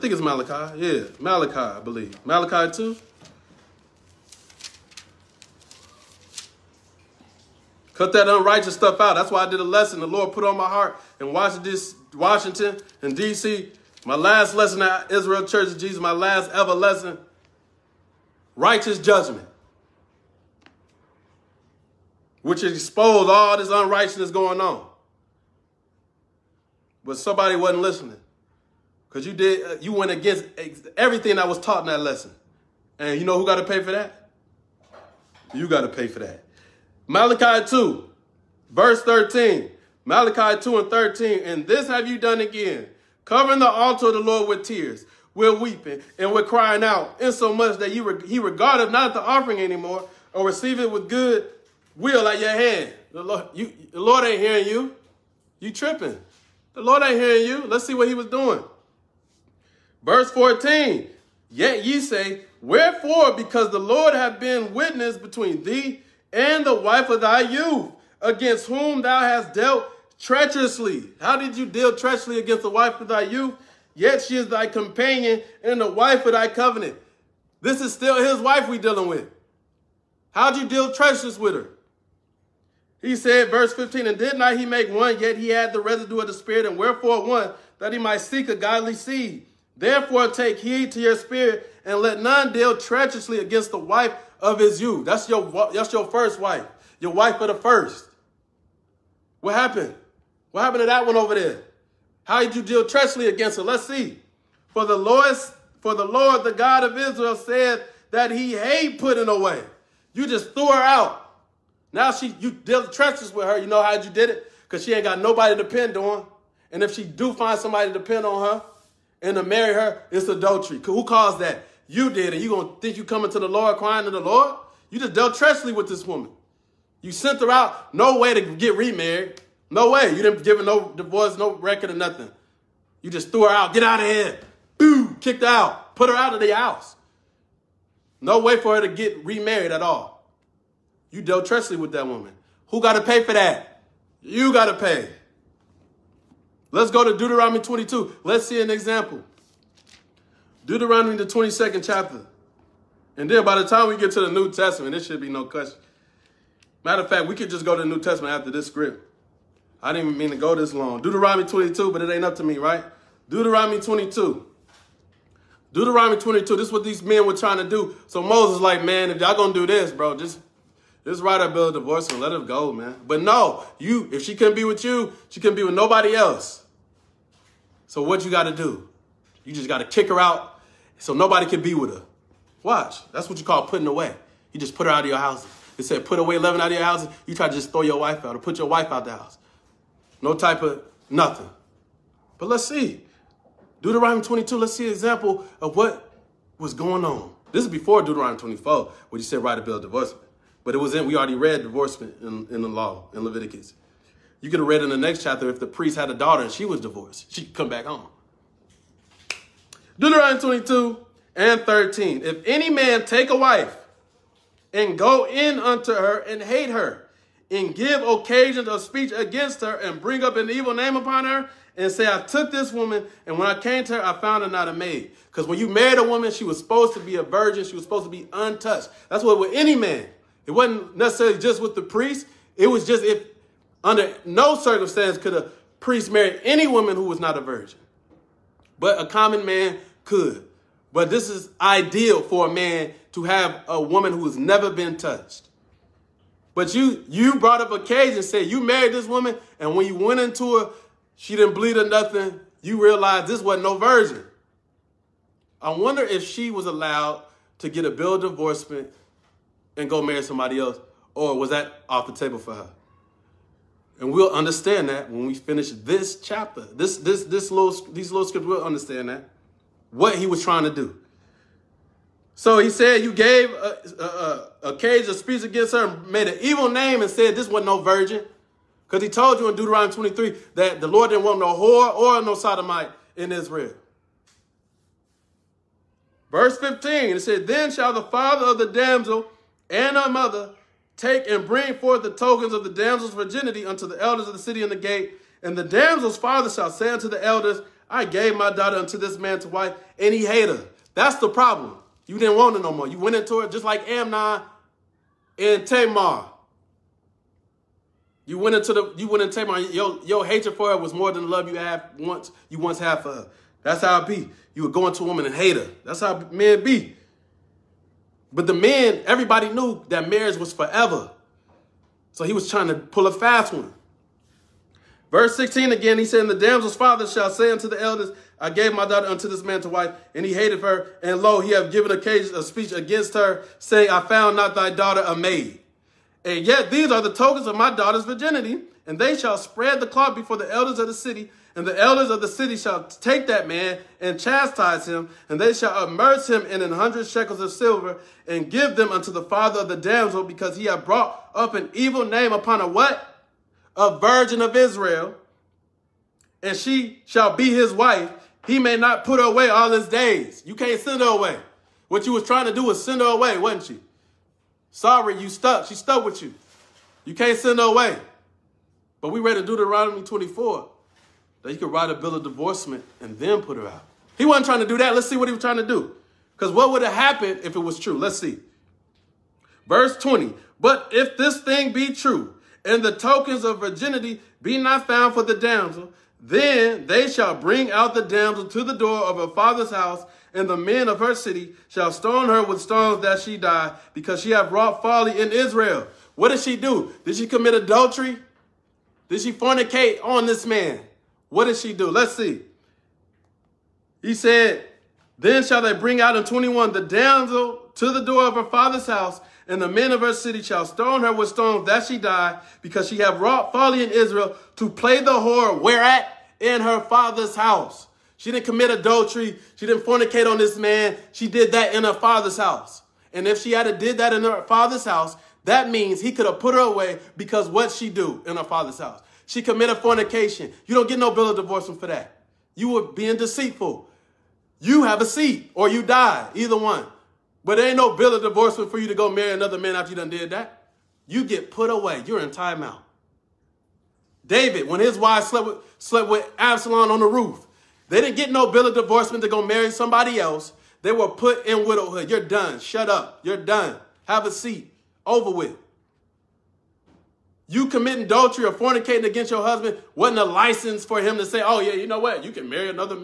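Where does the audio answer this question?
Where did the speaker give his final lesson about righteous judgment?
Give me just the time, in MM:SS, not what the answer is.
00:15.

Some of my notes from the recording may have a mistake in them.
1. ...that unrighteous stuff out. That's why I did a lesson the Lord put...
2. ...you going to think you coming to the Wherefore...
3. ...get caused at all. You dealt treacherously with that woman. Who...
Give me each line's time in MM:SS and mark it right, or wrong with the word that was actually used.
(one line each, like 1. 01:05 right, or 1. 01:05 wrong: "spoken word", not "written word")
1. 00:08 right
2. 02:02 wrong: "Lord", not "Wherefore"
3. 02:18 wrong: "remarried", not "caused".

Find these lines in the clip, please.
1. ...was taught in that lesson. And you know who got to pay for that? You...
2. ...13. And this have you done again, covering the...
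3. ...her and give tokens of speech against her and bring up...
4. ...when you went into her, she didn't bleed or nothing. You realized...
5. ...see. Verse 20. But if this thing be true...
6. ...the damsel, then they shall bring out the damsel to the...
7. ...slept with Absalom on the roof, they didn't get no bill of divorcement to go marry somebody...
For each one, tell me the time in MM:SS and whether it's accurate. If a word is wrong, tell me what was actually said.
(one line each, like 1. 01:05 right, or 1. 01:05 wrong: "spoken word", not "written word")
1. 00:31 right
2. 00:40 right
3. 03:36 wrong: "occasions", not "tokens"
4. 04:09 right
5. 06:18 right
6. 06:25 right
7. 07:25 right.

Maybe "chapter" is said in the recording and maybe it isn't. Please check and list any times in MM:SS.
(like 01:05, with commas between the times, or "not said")
02:31, 03:25, 04:26.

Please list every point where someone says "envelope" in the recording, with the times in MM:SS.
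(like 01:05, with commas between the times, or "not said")
not said.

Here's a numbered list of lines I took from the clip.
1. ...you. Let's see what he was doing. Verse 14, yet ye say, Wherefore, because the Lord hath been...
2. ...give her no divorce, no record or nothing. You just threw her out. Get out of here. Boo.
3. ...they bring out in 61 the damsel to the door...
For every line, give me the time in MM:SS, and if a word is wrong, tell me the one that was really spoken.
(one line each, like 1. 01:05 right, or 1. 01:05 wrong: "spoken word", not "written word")
1. 00:57 right
2. 02:10 right
3. 06:45 wrong: "21", not "61".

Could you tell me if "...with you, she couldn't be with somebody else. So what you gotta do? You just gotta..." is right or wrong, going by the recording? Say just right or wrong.
wrong.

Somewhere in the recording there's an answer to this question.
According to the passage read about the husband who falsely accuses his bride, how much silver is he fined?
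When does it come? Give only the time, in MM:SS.
05:46.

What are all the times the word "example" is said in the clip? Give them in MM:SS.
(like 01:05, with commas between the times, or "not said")
02:28, 03:14.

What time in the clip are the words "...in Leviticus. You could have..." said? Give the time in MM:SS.
03:23.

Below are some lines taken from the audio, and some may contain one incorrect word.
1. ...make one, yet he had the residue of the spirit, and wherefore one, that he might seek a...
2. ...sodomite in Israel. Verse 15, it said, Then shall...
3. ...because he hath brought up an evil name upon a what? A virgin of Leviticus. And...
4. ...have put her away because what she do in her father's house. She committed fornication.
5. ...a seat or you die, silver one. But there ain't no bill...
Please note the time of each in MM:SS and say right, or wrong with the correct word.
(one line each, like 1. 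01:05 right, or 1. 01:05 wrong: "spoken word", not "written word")
1. 01:24 right
2. 04:42 right
3. 05:50 wrong: "Israel", not "Leviticus"
4. 07:06 right
5. 07:15 wrong: "either", not "silver".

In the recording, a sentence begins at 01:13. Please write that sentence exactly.
Yet she is thy companion and the wife of thy covenant.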